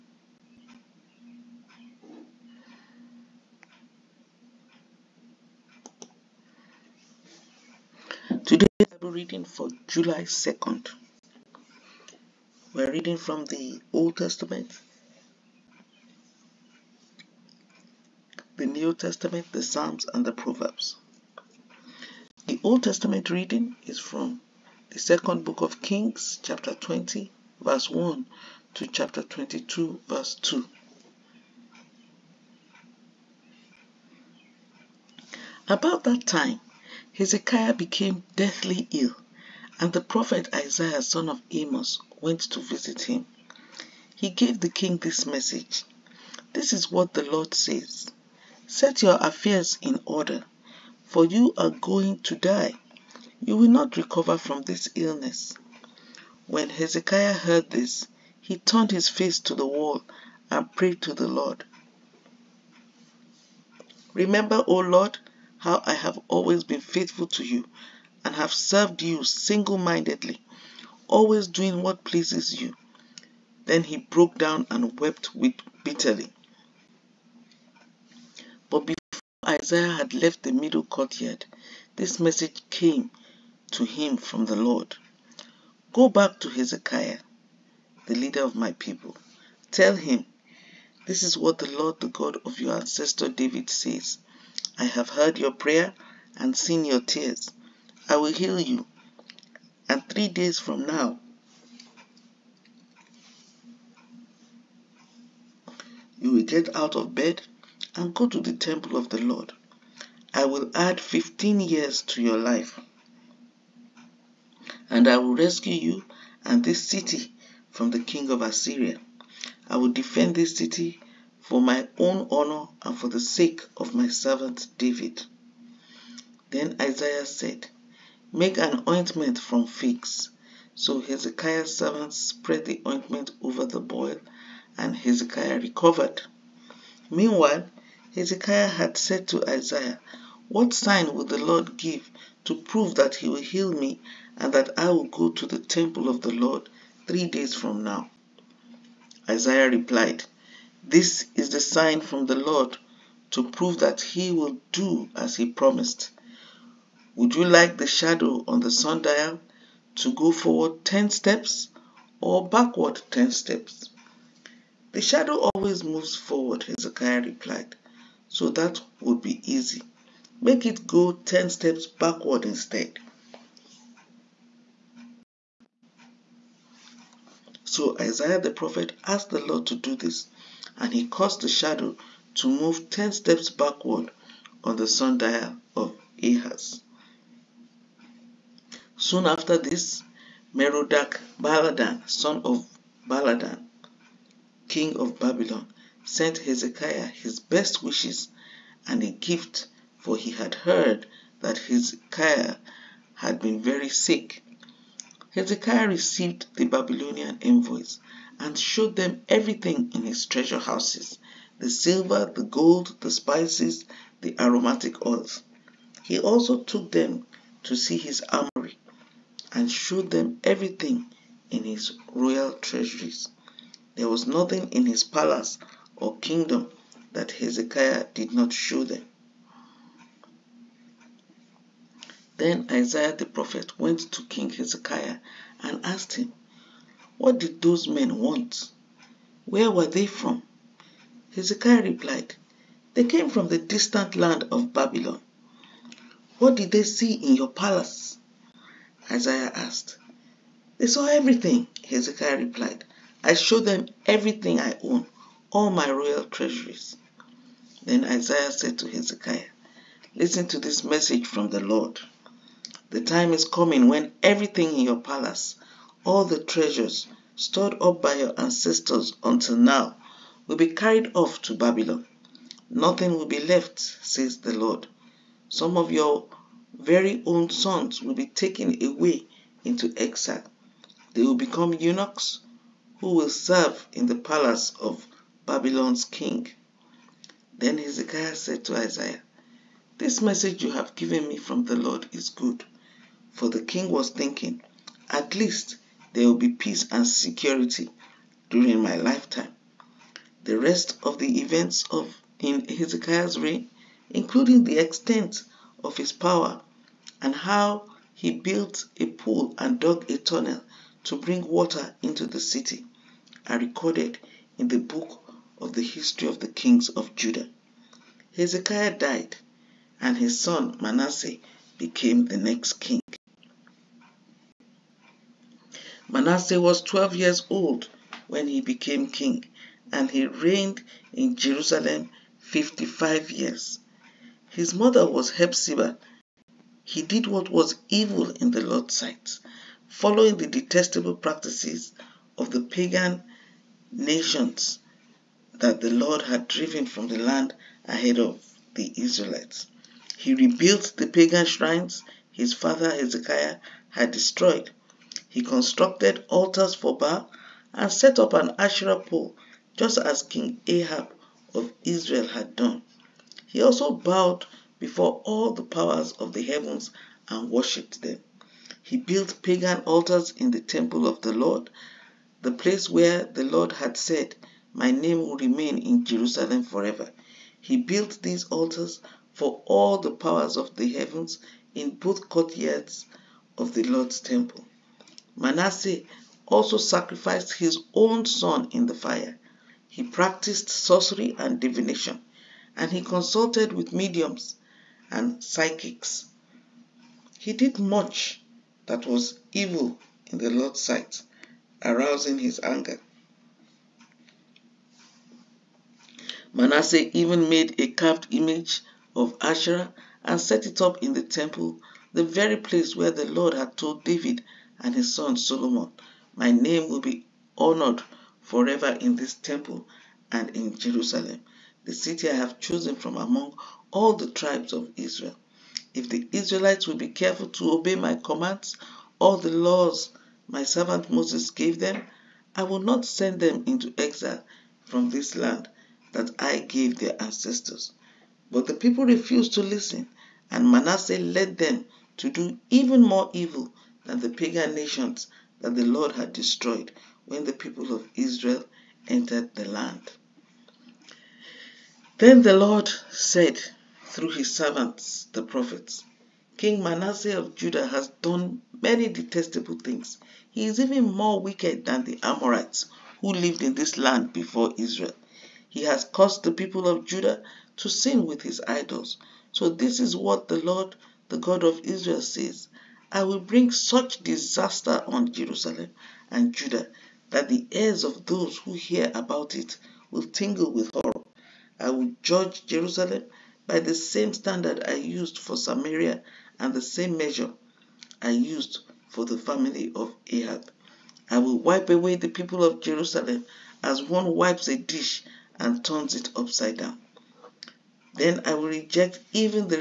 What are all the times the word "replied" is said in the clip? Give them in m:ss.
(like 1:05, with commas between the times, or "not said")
2:29, 2:47, 4:01, 4:12.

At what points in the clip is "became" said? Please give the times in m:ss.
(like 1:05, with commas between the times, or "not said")
0:37, 5:21, 5:28.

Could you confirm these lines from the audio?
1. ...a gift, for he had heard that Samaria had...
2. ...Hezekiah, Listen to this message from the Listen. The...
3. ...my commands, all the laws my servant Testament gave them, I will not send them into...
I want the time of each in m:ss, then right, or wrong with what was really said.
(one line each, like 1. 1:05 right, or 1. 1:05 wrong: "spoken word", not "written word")
1. 3:19 wrong: "Hezekiah", not "Samaria"
2. 4:18 wrong: "Lord", not "Listen"
3. 7:07 wrong: "Moses", not "Testament".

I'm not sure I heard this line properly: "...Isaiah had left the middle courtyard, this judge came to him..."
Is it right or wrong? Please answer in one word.
wrong.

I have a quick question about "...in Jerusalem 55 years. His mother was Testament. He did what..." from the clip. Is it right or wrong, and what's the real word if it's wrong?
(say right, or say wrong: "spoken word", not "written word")
wrong: "Hephzibah", not "Testament".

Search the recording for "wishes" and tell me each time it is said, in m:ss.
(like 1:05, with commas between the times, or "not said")
3:17.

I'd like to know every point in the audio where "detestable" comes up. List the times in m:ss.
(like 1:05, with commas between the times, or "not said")
5:40, 7:39.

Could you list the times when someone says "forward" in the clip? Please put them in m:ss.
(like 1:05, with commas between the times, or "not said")
2:40, 2:46.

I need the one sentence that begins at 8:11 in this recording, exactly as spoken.
I will wipe away the people of Jerusalem as one wipes a dish and turns it upside down.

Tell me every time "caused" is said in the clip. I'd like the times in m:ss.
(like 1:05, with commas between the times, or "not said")
3:01, 7:46.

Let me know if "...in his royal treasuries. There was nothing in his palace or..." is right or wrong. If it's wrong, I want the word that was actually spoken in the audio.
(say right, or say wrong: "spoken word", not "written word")
right.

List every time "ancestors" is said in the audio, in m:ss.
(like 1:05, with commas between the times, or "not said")
1:32, 4:28, 7:17.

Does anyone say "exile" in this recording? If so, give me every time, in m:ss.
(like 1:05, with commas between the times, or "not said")
4:39, 7:13.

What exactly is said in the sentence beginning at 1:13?
Then he broke down and wept with bitterly.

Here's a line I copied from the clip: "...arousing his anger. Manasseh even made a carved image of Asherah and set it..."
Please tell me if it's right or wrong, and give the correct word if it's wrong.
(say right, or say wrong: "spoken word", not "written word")
right.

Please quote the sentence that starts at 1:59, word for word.
I will defend this city for my own honor and for the sake of my servant David.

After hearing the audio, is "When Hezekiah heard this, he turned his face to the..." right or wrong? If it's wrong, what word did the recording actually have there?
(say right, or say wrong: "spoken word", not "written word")
right.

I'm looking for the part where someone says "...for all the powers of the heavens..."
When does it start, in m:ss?
6:19.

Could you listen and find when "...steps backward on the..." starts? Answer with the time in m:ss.
3:03.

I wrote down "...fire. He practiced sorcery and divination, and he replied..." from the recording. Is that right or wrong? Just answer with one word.
wrong.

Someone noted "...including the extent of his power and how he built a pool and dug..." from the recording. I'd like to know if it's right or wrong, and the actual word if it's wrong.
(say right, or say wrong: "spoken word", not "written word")
right.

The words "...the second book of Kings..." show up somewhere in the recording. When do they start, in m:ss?
0:24.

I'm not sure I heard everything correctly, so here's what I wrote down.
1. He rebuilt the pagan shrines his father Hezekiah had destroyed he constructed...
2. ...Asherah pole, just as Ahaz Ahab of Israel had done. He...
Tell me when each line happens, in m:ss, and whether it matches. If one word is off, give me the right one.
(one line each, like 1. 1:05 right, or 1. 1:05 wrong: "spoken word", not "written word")
1. 5:50 right
2. 5:58 wrong: "King", not "Ahaz".